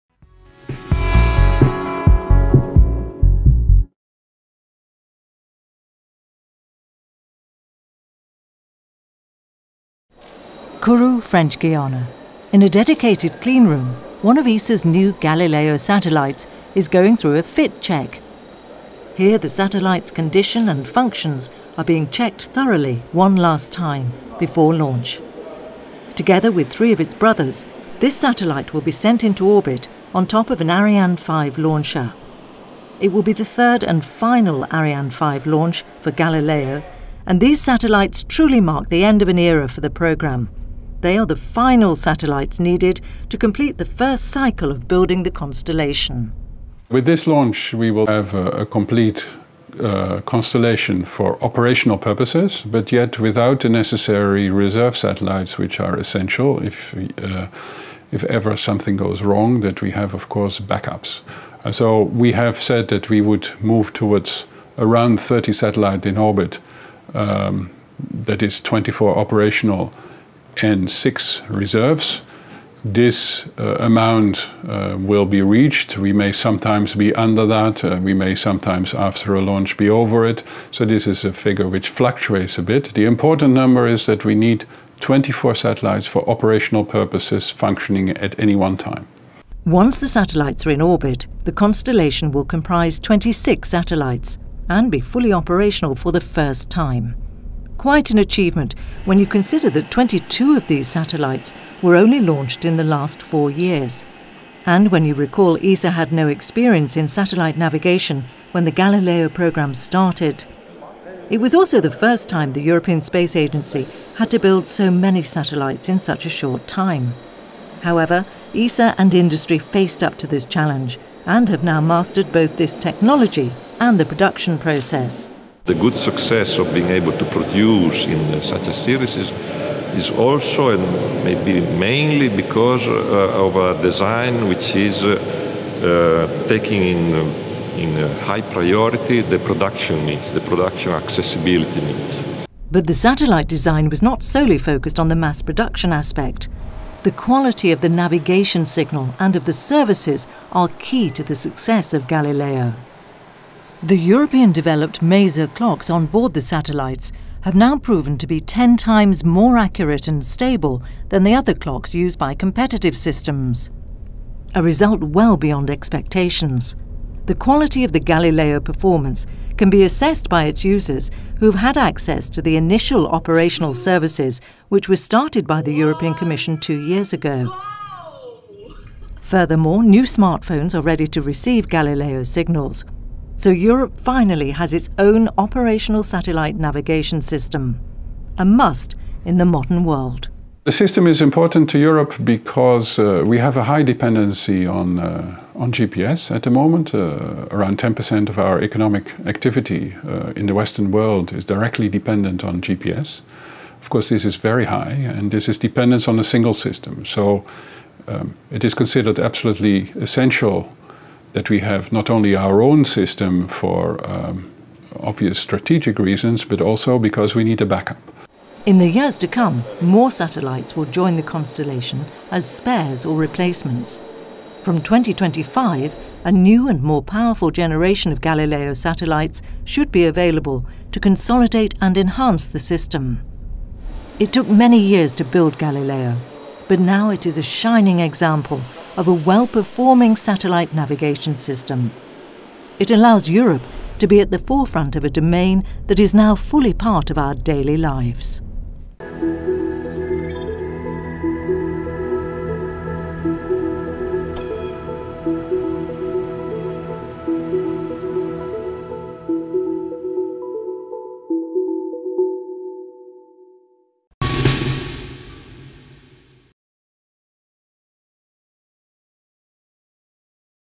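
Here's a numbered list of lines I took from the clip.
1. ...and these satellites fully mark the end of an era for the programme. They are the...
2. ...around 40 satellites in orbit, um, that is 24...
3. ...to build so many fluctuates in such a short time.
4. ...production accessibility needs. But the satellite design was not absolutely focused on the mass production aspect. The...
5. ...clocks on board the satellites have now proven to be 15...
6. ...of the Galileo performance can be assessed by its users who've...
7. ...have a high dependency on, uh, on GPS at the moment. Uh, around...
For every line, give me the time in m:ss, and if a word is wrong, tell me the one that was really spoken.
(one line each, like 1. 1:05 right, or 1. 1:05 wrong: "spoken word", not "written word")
1. 0:37 wrong: "truly", not "fully"
2. 1:04 wrong: "30", not "40"
3. 1:54 wrong: "satellites", not "fluctuates"
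4. 2:20 wrong: "solely", not "absolutely"
5. 2:35 wrong: "10", not "15"
6. 2:47 right
7. 3:13 right.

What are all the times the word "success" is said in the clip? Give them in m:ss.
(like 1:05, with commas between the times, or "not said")
2:05, 2:31.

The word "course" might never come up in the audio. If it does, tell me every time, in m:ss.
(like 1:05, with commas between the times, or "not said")
1:00, 3:23.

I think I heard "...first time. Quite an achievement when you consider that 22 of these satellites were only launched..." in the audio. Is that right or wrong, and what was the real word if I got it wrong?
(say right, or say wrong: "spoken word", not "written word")
right.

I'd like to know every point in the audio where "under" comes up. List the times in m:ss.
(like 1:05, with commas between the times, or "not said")
1:17.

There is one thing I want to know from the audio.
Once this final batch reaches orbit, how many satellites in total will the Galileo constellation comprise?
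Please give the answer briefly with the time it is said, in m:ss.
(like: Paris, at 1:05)
26, at 1:32.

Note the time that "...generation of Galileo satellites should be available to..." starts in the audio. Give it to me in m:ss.
3:47.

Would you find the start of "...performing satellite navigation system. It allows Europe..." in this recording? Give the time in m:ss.
3:59.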